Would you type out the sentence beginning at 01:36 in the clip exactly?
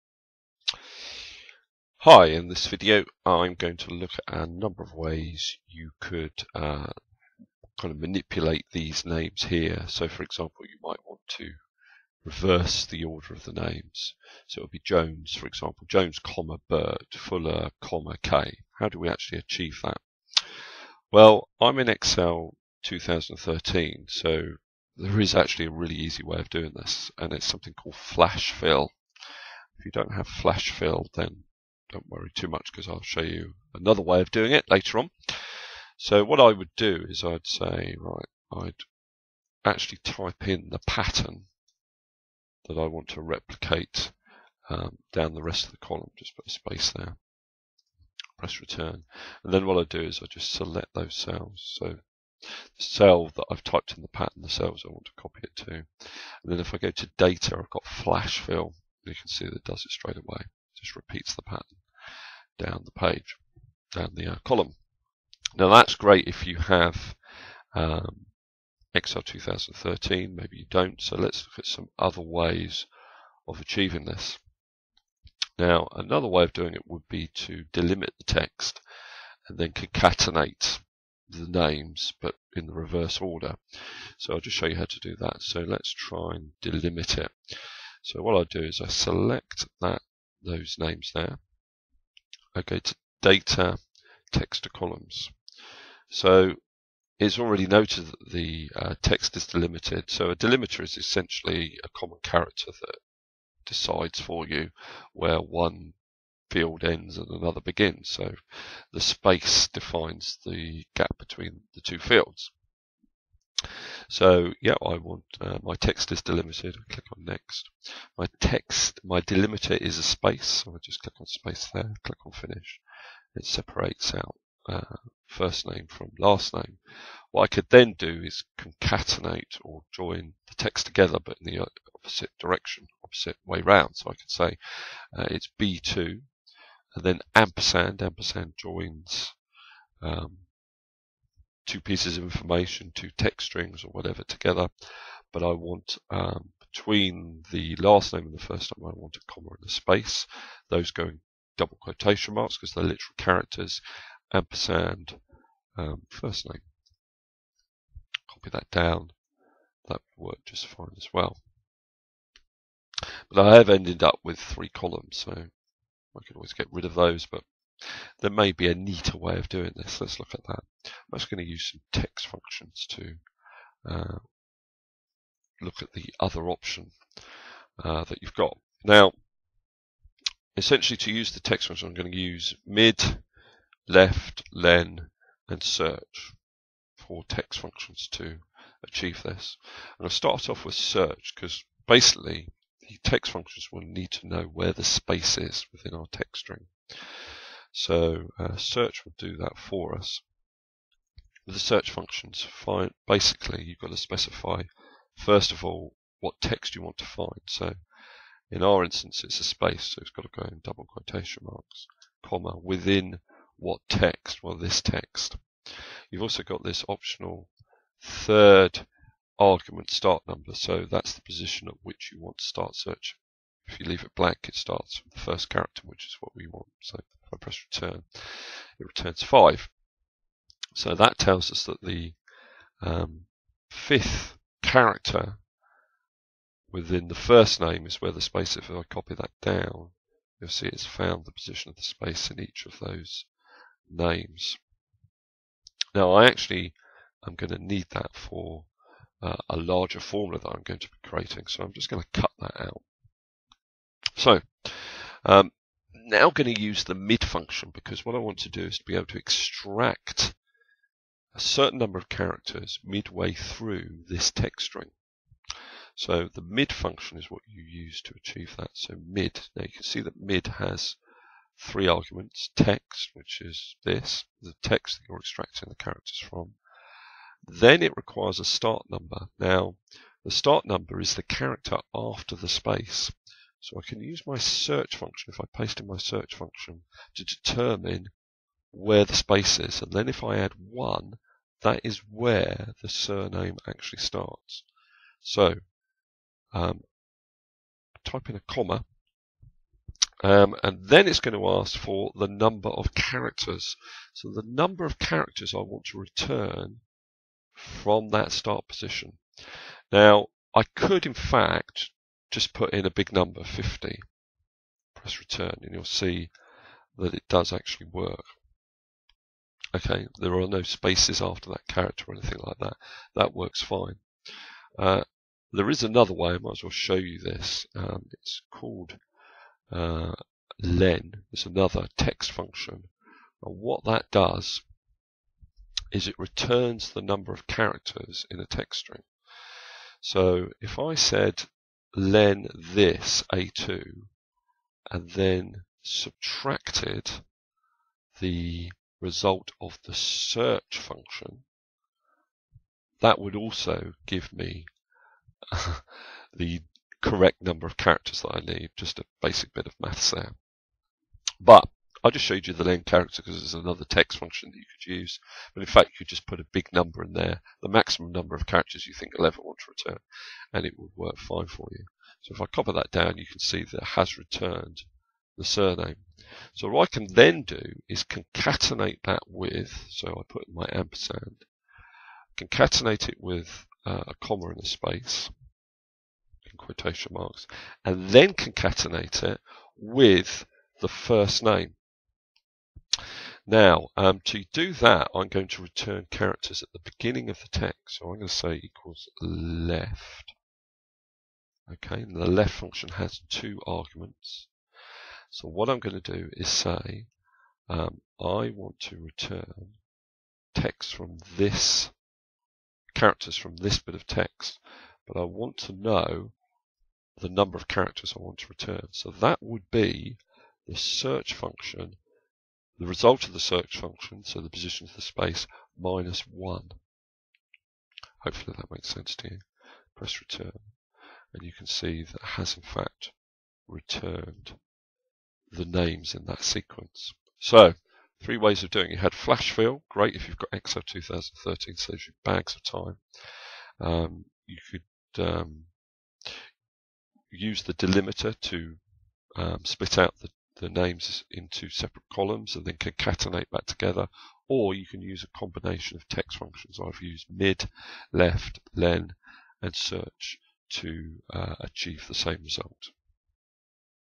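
So it's already noted that the uh, text is delimited.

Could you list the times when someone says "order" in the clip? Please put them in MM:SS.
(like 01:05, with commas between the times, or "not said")
00:13, 01:23.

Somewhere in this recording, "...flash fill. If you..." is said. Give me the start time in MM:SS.
00:27.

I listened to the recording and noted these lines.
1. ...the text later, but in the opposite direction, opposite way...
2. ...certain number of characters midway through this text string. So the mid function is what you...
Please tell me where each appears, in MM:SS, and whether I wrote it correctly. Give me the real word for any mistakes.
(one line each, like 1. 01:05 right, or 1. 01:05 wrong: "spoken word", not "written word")
1. 02:10 wrong: "together", not "later"
2. 04:21 right.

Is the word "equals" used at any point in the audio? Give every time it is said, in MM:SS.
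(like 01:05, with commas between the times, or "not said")
06:38.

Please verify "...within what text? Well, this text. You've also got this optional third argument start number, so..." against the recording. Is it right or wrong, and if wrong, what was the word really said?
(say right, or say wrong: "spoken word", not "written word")
right.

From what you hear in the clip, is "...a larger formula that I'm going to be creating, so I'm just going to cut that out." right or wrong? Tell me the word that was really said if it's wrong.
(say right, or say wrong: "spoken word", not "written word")
right.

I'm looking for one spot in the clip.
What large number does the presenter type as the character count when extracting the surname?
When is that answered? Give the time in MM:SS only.
05:13.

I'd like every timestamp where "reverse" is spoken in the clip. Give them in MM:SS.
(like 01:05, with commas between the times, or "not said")
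00:12, 01:22.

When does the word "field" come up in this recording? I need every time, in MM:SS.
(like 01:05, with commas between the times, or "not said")
01:46, 01:51.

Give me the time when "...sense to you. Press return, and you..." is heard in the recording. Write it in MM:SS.
07:08.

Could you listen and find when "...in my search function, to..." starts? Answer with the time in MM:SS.
04:45.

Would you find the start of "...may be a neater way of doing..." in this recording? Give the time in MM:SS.
02:48.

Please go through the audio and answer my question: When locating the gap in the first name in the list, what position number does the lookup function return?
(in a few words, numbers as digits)
5.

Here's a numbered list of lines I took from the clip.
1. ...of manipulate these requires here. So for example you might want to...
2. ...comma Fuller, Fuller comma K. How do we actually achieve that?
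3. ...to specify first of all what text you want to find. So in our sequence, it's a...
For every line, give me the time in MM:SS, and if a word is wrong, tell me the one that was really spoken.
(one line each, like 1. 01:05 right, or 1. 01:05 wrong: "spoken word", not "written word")
1. 00:07 wrong: "names", not "requires"
2. 00:16 wrong: "Bird", not "Fuller"
3. 03:23 wrong: "instance", not "sequence".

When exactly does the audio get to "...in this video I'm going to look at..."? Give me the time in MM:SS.
00:02.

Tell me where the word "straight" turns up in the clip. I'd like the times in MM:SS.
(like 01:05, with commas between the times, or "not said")
00:59.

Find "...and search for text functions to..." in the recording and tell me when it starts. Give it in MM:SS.
03:05.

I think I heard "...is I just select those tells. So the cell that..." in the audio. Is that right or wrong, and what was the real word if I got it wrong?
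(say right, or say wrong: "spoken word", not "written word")
wrong: "cells", not "tells".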